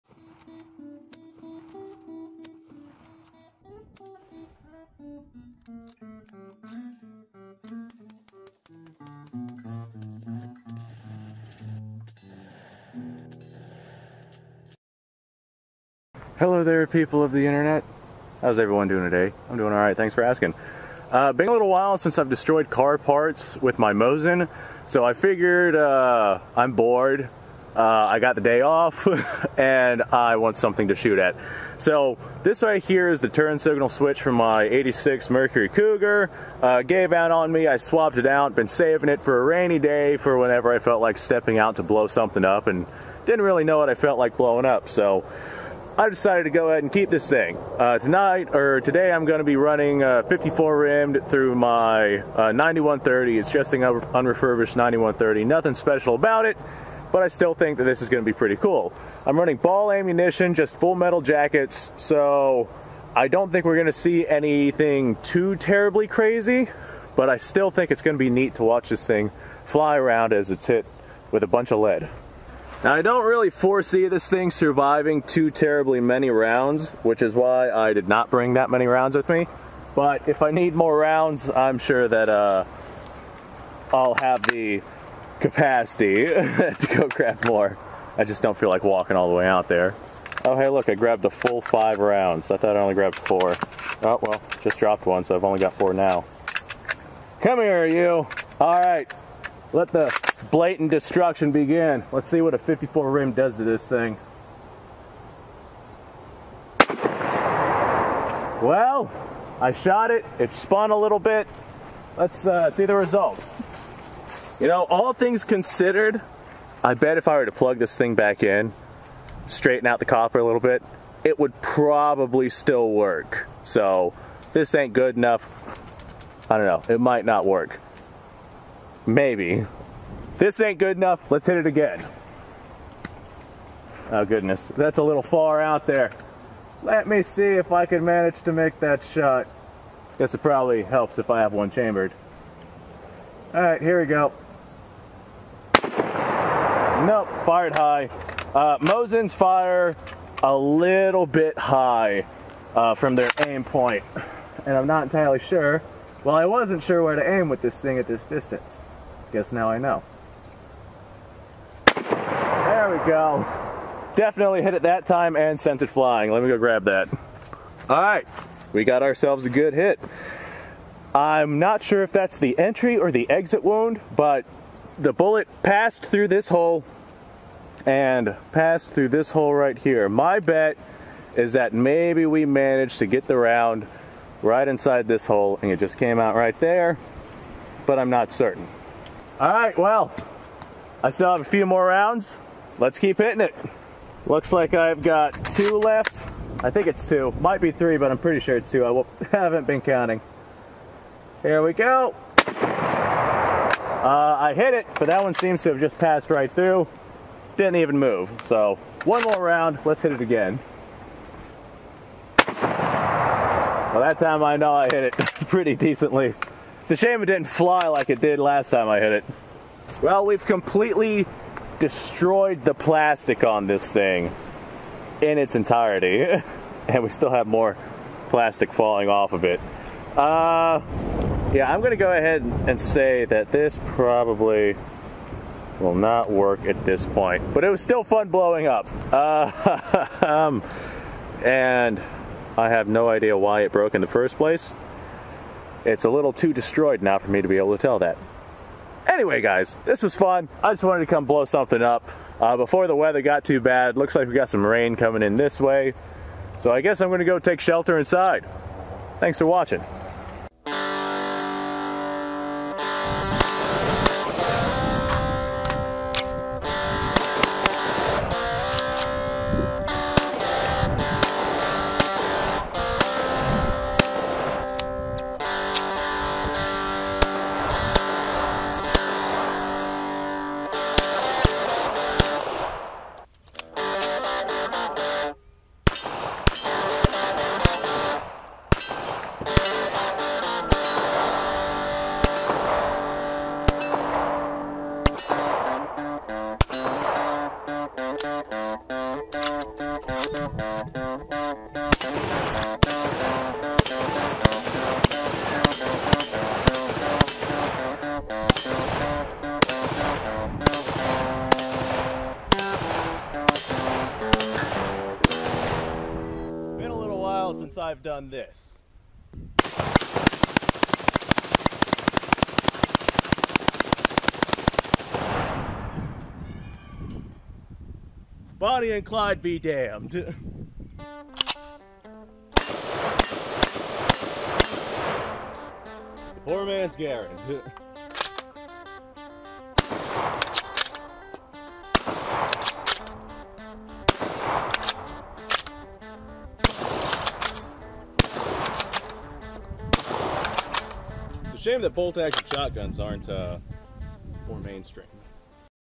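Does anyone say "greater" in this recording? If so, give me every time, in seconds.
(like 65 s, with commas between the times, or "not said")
not said.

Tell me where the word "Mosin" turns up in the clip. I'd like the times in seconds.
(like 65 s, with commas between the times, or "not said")
23 s, 148 s.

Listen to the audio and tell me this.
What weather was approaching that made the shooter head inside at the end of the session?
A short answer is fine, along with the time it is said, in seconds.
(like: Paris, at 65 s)
rain, at 254 s.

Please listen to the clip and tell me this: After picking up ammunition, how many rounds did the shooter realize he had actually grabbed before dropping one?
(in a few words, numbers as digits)
5.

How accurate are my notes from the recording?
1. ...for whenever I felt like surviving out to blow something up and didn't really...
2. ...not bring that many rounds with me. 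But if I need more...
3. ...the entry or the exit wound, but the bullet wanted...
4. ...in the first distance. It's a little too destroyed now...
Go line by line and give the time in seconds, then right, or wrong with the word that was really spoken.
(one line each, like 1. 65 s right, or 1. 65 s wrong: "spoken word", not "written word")
1. 40 s wrong: "stepping", not "surviving"
2. 78 s right
3. 172 s wrong: "passed", not "wanted"
4. 243 s wrong: "place", not "distance".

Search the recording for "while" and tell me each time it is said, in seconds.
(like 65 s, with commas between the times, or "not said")
21 s, 317 s.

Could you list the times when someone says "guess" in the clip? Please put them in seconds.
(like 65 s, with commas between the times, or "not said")
140 s, 159 s, 256 s.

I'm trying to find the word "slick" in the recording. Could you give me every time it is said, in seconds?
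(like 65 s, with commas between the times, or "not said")
not said.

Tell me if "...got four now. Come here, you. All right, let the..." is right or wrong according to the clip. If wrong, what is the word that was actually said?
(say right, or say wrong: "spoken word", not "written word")
right.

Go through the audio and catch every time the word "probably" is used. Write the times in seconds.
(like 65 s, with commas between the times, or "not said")
121 s, 140 s, 233 s.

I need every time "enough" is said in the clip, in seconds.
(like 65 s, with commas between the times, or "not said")
125 s, 130 s.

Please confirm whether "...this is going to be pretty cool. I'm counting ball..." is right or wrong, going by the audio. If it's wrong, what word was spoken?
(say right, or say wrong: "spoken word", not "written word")
wrong: "running", not "counting".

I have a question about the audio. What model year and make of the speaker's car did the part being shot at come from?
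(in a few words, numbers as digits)
86 Mercury Cougar.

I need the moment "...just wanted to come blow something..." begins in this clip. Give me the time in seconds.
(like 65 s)
250 s.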